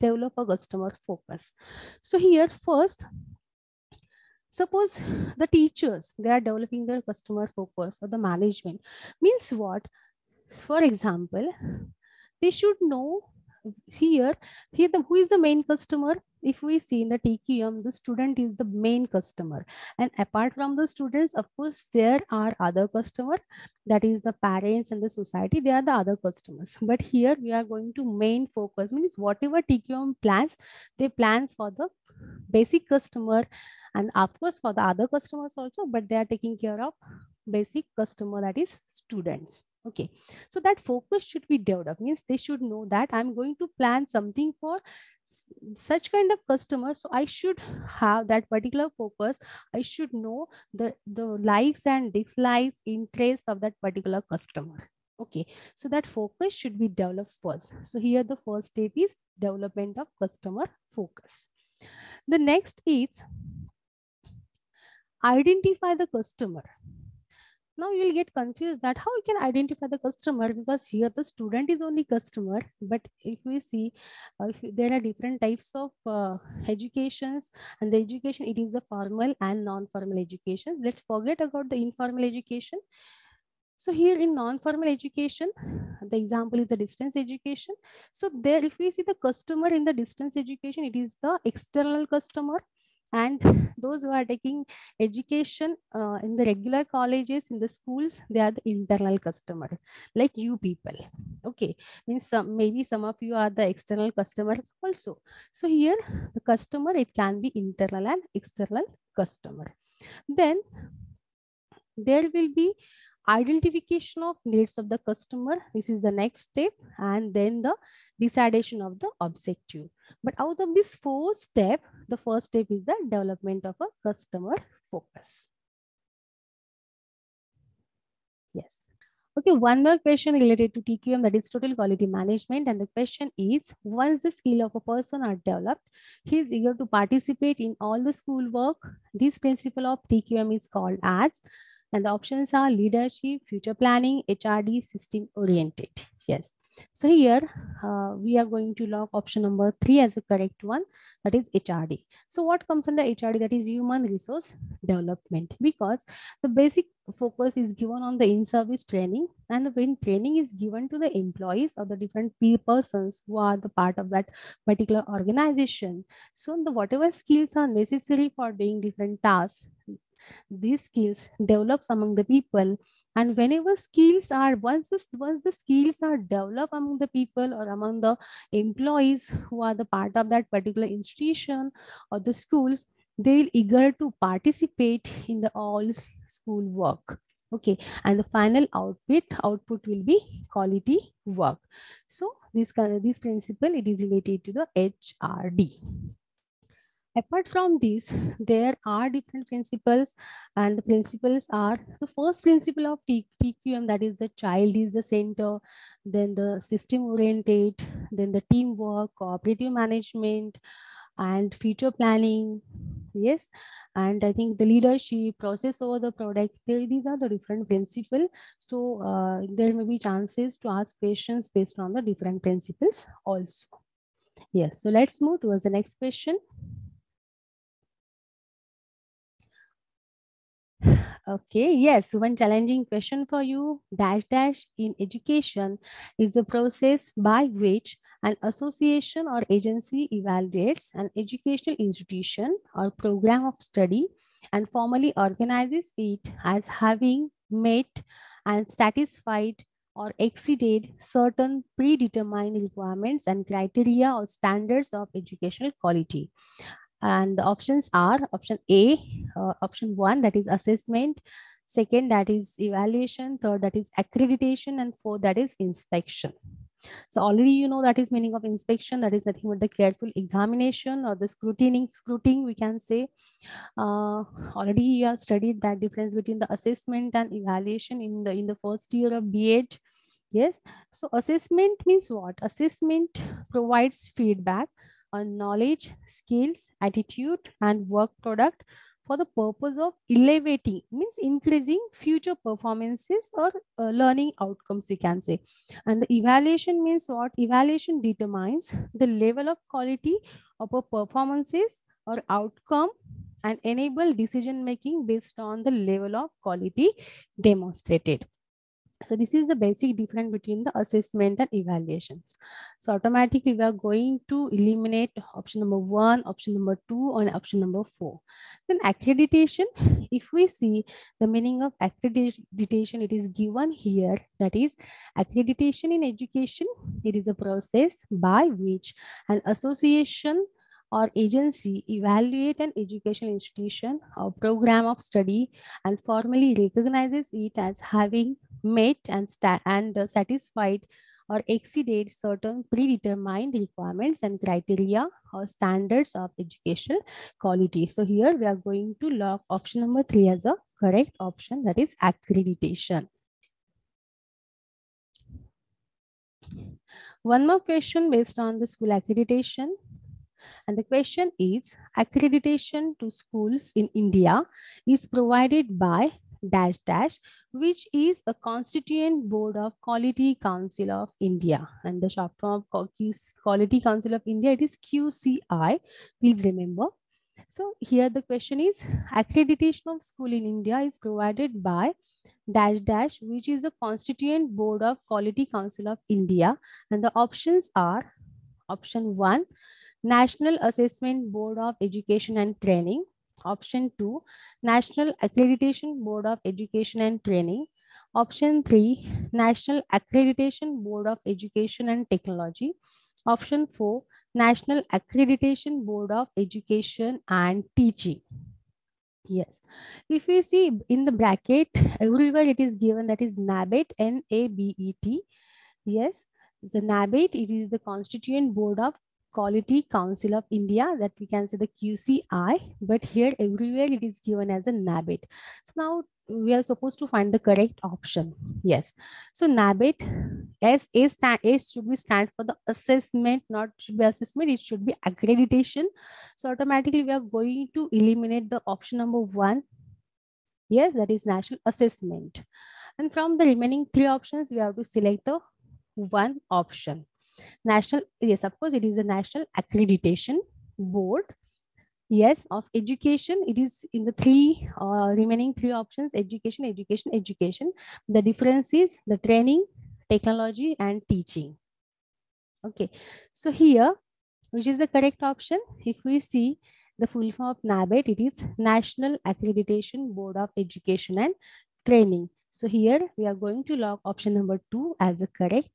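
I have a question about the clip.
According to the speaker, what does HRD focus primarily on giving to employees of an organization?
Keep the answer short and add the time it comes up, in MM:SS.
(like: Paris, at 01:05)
In-service training, at 02:38.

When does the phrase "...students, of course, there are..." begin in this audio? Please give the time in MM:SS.
00:20.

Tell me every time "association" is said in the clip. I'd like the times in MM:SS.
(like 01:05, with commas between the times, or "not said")
03:58, 05:29.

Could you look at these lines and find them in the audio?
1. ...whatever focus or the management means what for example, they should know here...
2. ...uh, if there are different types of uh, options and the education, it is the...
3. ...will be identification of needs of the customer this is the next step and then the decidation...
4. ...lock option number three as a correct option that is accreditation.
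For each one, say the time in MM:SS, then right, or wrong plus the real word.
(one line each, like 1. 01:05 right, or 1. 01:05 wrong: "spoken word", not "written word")
1. 00:07 wrong: "customer", not "whatever"
2. 01:14 wrong: "educations", not "options"
3. 01:52 right
4. 05:49 right.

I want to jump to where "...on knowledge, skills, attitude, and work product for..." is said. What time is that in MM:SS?
04:45.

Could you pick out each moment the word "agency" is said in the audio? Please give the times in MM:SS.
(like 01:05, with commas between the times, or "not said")
03:59, 05:31.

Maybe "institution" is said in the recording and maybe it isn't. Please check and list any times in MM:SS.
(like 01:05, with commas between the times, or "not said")
03:00, 04:01, 05:33.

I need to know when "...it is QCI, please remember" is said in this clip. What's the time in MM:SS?
06:14.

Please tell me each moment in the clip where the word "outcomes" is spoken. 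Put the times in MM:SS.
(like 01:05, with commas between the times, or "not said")
04:54, 05:02.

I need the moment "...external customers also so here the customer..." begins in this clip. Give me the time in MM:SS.
01:43.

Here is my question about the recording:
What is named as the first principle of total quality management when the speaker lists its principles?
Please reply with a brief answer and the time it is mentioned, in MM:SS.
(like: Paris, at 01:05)
The child is the center, at 03:24.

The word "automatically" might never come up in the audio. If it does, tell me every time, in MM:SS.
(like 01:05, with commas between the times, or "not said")
05:12, 07:16.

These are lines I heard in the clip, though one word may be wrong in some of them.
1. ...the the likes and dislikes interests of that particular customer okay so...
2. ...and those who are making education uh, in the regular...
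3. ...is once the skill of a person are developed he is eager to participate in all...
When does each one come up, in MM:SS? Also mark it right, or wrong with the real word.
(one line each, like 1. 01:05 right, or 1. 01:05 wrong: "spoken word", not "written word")
1. 00:50 right
2. 01:33 wrong: "taking", not "making"
3. 02:13 right.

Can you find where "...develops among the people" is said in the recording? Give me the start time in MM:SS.
02:51.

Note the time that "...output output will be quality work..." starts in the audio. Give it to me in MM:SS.
03:08.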